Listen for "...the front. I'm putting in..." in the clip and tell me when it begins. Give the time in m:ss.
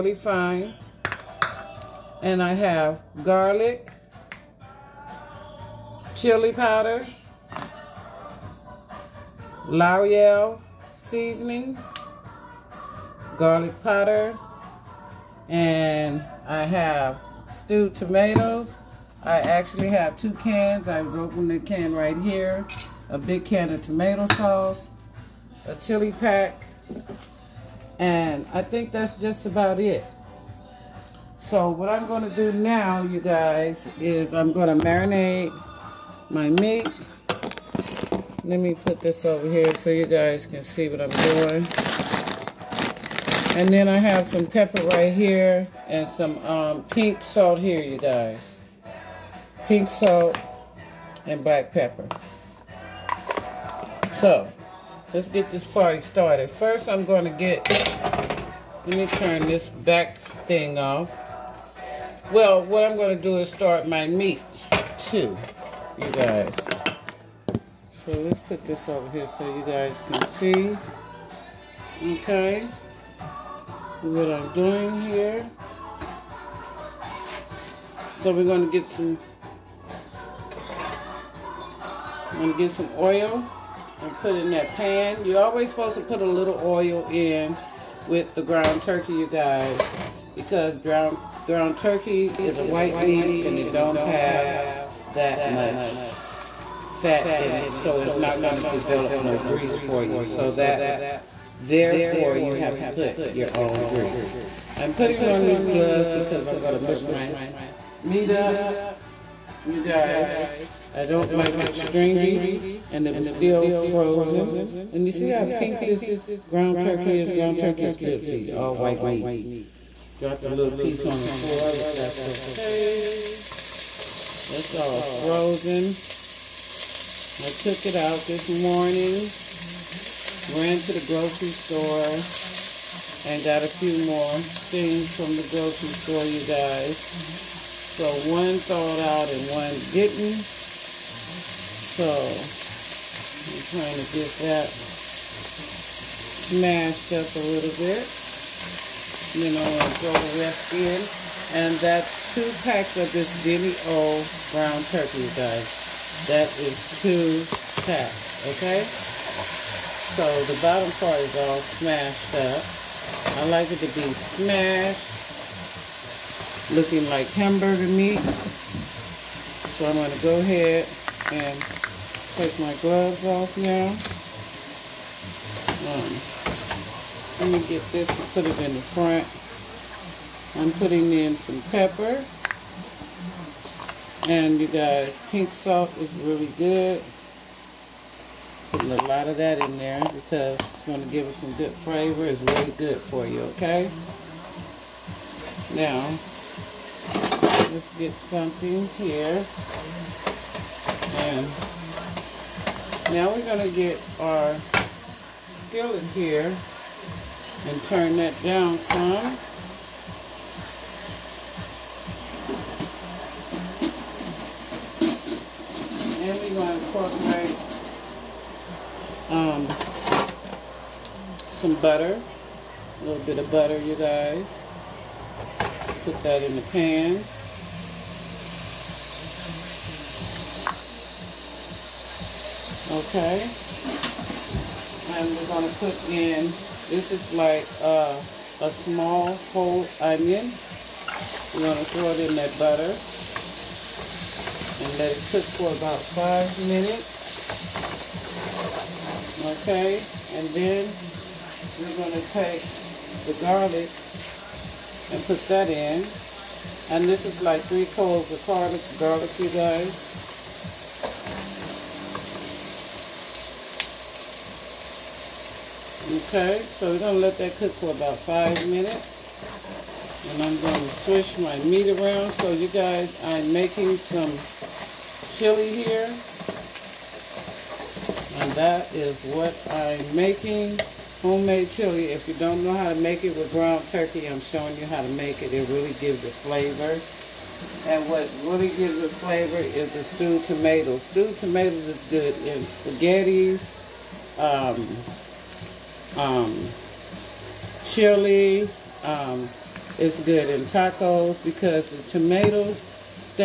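2:58.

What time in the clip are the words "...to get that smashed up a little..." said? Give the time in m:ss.
2:23.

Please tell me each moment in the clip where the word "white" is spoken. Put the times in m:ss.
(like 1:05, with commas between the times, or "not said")
1:32, 1:58.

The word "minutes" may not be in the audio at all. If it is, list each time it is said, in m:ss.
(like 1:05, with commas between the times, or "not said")
4:06, 4:28.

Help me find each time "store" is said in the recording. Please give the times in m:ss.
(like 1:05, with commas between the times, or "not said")
2:11, 2:15.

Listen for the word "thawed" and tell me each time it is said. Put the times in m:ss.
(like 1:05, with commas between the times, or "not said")
2:18.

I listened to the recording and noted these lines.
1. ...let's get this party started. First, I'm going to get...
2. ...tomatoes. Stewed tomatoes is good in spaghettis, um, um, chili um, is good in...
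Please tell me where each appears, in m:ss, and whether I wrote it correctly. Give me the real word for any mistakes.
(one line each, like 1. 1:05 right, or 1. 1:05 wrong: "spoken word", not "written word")
1. 0:55 right
2. 4:50 right.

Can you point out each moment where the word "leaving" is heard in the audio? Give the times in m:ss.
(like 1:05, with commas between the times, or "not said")
not said.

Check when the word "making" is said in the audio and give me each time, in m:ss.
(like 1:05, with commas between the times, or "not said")
4:33, 4:40.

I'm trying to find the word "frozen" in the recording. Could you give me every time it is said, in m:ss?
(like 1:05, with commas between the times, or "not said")
1:53, 2:05.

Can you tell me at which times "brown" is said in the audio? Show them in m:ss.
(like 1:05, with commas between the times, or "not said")
2:34.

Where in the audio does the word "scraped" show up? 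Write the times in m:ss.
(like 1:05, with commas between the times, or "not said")
not said.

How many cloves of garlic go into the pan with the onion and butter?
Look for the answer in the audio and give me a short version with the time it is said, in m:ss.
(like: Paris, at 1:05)
3, at 4:17.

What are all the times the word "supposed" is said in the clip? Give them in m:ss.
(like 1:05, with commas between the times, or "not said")
1:25.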